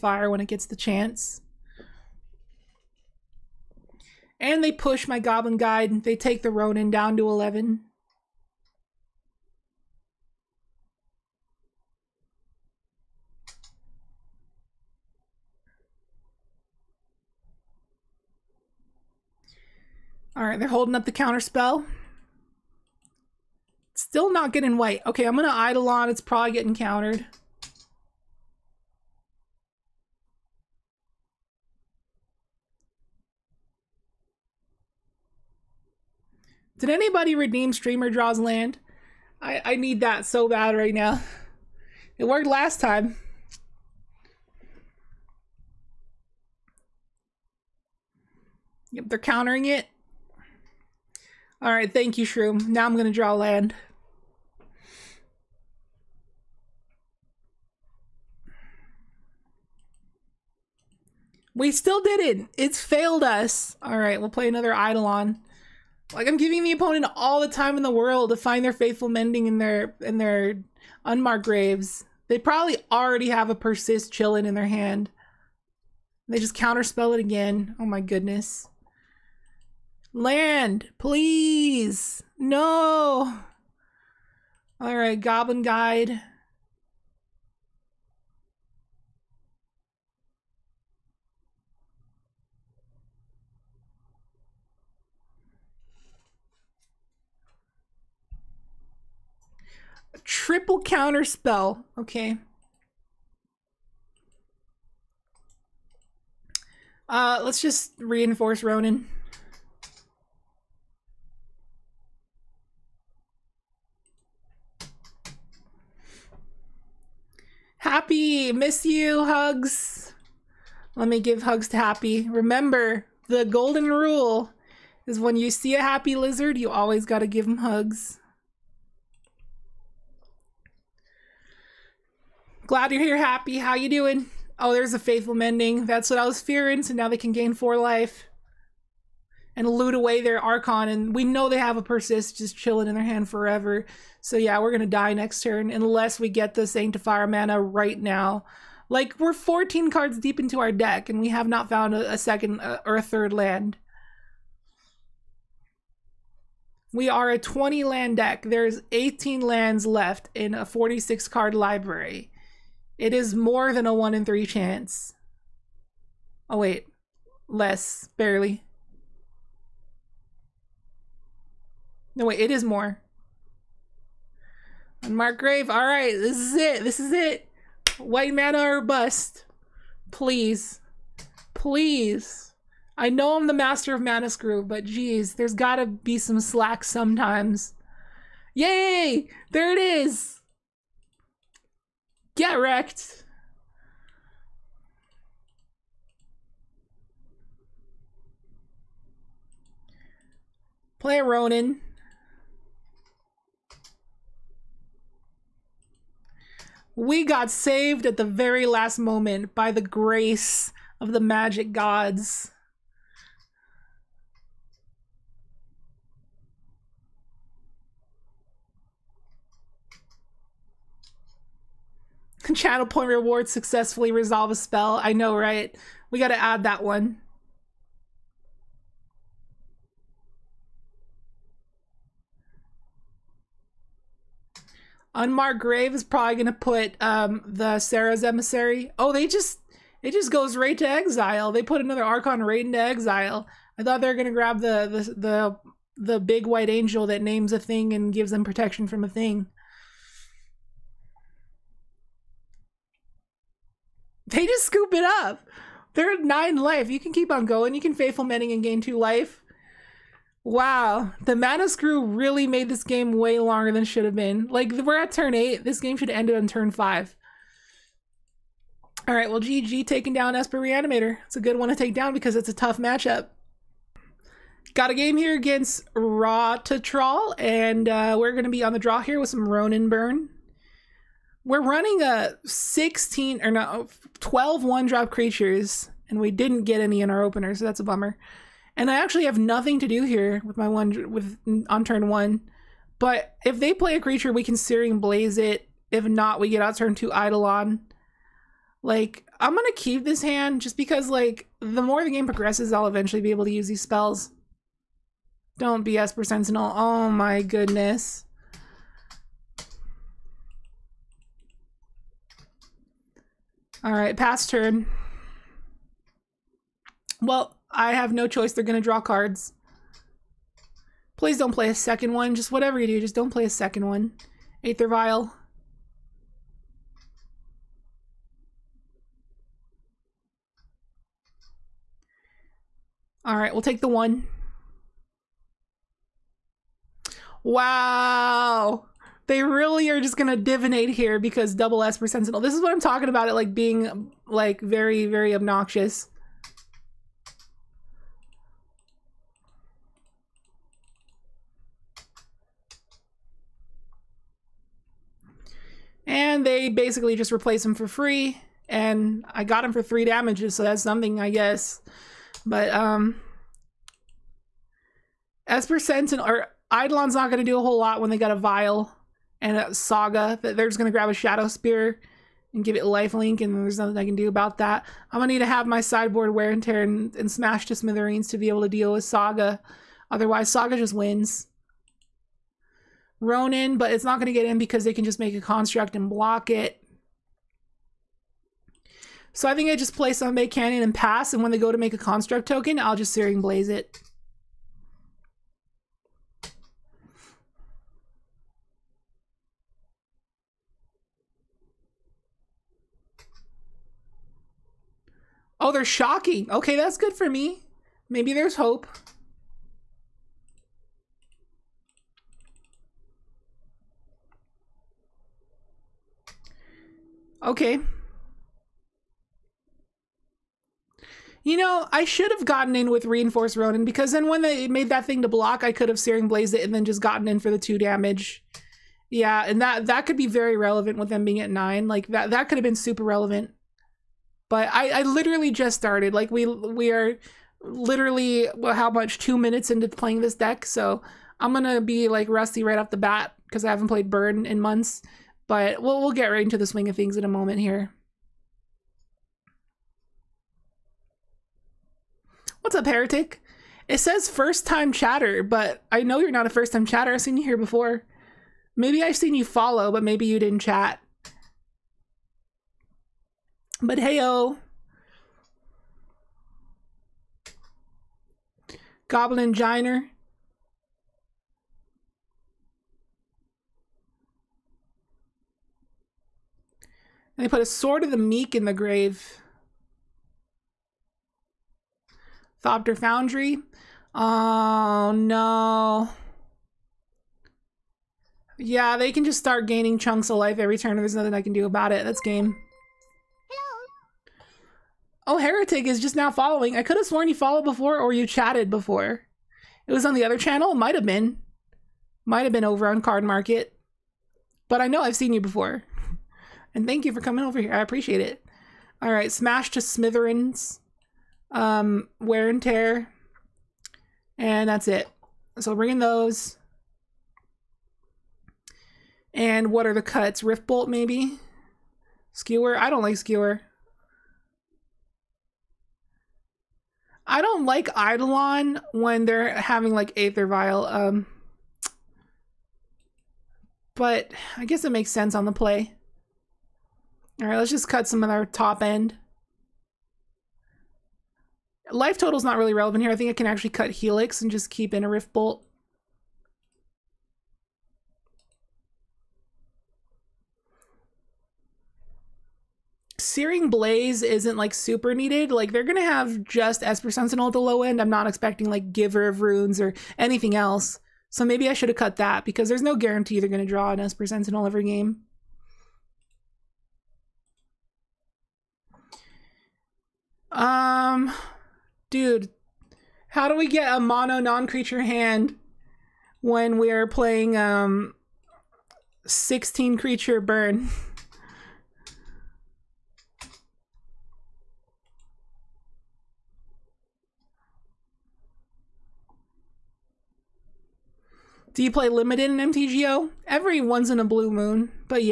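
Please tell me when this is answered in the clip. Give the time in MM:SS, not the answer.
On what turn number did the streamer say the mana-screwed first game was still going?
04:25.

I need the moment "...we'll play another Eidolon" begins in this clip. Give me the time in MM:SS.
01:04.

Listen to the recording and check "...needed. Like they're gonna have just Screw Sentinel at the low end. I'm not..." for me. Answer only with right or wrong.
wrong.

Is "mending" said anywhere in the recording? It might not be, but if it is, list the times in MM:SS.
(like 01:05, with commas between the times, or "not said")
01:09, 02:15, 04:18.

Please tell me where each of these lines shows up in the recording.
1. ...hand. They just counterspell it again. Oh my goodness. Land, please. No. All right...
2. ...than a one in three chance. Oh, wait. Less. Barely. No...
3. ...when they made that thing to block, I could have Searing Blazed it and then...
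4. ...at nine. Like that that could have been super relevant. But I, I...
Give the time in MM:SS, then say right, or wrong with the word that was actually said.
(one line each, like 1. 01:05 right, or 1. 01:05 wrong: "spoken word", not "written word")
1. 01:14 right
2. 02:43 right
3. 07:04 right
4. 07:11 right.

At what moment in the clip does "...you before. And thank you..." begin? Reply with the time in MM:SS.
08:25.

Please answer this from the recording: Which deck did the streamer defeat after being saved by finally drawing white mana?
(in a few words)
Esper Reanimator.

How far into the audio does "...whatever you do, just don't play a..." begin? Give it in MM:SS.
05:22.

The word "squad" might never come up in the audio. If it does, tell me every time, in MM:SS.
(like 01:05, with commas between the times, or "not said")
not said.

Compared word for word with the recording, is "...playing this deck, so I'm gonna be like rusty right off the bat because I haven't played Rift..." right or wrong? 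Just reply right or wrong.
wrong.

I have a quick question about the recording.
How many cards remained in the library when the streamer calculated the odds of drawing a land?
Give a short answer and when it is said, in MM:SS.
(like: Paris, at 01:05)
46, at 02:40.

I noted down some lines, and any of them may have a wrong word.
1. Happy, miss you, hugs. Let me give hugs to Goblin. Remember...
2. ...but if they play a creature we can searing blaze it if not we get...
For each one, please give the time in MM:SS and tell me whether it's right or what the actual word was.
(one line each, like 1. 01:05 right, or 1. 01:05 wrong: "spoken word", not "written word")
1. 01:57 wrong: "Happy", not "Goblin"
2. 04:52 right.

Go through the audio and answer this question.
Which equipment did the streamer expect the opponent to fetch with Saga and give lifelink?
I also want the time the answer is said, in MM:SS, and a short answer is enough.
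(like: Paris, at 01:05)
Shadowspear, at 06:11.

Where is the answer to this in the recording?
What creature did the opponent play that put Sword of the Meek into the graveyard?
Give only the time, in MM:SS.
07:49.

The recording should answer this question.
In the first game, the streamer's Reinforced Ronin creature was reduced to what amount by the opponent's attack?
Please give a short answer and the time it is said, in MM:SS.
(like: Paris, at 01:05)
11, at 00:07.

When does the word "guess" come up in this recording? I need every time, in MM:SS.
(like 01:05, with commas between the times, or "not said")
06:01, 08:54.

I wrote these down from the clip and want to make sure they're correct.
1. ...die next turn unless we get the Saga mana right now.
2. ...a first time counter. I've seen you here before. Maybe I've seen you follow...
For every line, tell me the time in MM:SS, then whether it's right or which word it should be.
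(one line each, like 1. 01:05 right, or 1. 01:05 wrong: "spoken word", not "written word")
1. 02:24 wrong: "Sanctifier", not "Saga"
2. 07:36 wrong: "chatter", not "counter".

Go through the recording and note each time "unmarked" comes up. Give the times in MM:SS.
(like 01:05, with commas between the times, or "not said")
01:11, 03:55.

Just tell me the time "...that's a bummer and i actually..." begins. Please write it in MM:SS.
04:47.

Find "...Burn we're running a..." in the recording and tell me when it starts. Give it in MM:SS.
04:39.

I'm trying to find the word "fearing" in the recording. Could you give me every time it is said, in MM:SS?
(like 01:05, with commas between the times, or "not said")
02:16.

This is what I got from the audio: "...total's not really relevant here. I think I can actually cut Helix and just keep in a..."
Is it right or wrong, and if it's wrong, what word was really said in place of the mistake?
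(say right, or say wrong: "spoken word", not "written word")
right.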